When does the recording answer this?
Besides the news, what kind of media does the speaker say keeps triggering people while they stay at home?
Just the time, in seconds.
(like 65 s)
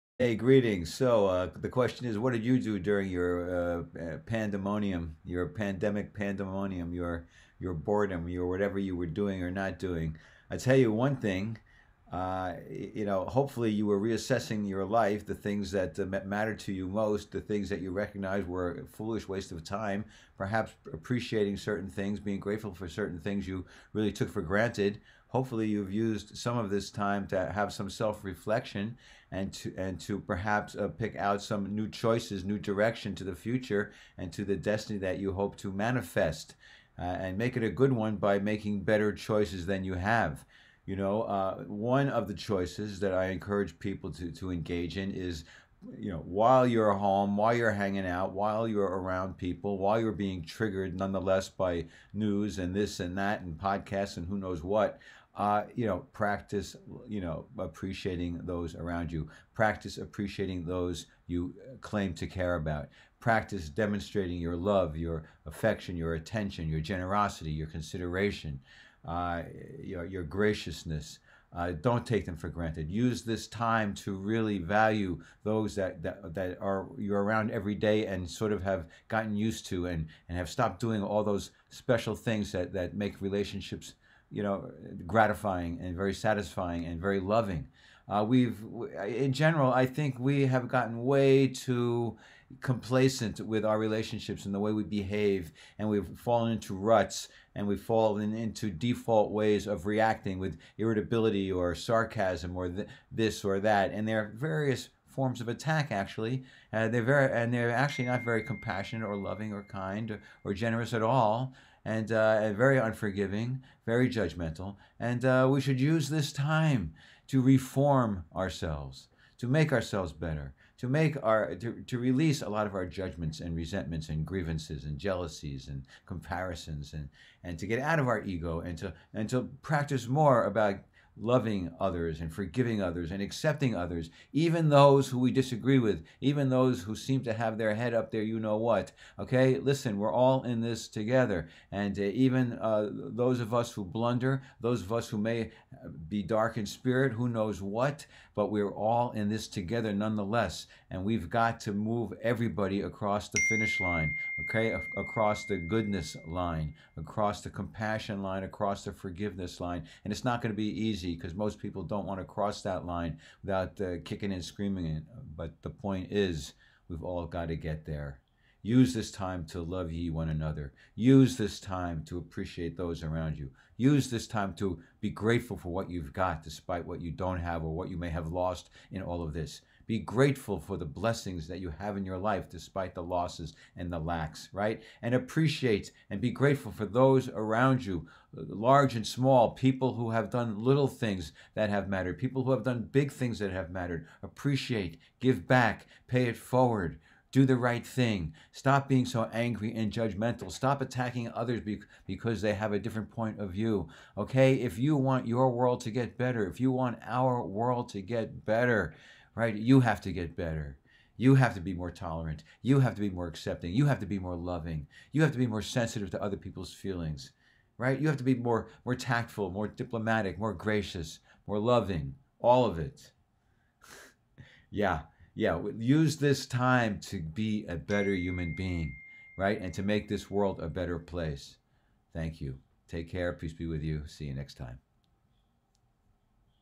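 53 s.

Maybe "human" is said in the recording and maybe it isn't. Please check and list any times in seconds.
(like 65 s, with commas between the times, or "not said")
228 s.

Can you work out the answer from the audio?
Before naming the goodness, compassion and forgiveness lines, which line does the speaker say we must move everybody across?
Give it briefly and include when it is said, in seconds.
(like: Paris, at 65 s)
finish line, at 153 s.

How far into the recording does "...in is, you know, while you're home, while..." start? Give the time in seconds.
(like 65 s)
44 s.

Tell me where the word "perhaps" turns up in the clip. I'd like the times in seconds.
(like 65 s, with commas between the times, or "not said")
20 s, 30 s.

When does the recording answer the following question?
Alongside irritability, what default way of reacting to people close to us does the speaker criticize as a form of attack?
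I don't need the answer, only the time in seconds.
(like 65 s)
101 s.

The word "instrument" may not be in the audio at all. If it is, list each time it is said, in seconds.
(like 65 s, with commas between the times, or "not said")
not said.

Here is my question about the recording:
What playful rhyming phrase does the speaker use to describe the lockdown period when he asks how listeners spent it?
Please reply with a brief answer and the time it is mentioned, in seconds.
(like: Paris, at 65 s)
pandemic pandemonium, at 5 s.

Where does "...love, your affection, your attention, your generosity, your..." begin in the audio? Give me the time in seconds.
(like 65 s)
64 s.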